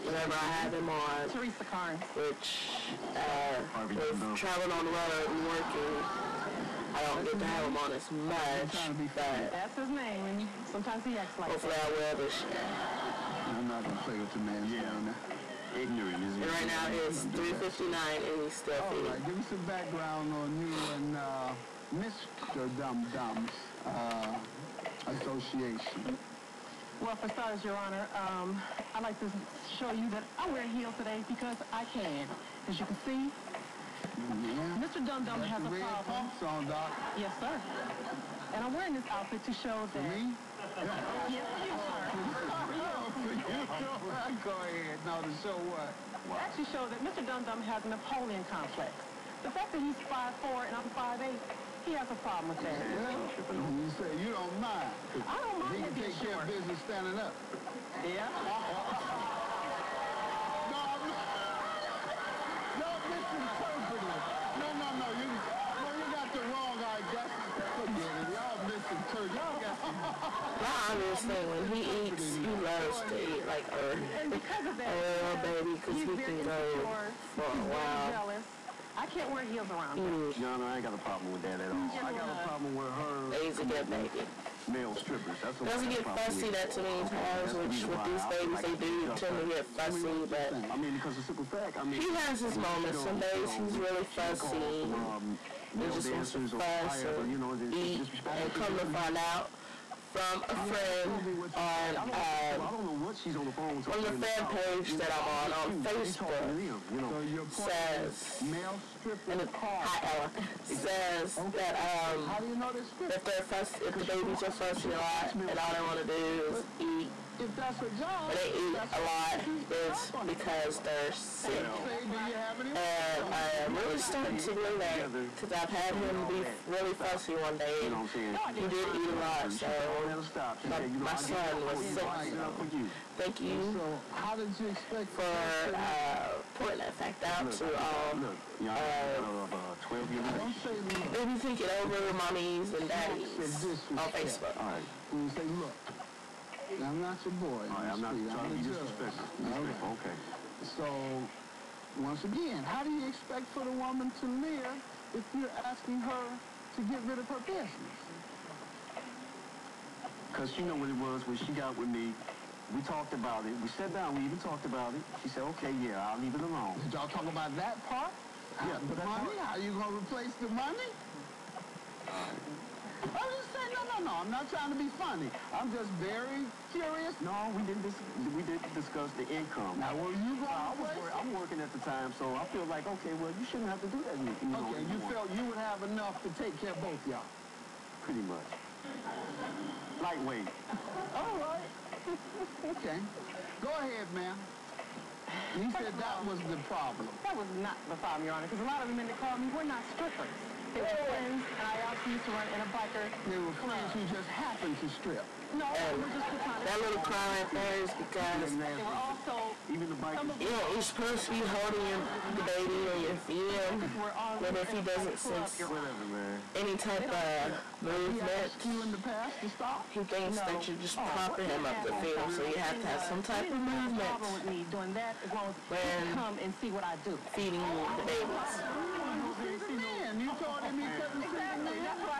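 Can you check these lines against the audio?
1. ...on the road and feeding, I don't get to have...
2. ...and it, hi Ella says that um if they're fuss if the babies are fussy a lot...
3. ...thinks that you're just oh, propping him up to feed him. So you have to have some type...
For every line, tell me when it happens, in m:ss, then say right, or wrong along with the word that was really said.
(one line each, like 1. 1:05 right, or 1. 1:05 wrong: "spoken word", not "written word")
1. 0:04 wrong: "working", not "feeding"
2. 1:49 right
3. 3:40 right.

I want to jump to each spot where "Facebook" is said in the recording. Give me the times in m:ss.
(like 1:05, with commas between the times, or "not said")
1:45, 2:24.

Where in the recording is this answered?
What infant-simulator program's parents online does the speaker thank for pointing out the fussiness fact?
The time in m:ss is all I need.
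2:21.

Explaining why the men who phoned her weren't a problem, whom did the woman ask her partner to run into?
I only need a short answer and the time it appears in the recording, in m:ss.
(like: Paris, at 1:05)
a biker, at 3:22.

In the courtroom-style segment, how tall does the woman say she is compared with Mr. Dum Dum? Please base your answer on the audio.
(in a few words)
5'8.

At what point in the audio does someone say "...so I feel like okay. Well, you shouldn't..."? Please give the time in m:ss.
3:02.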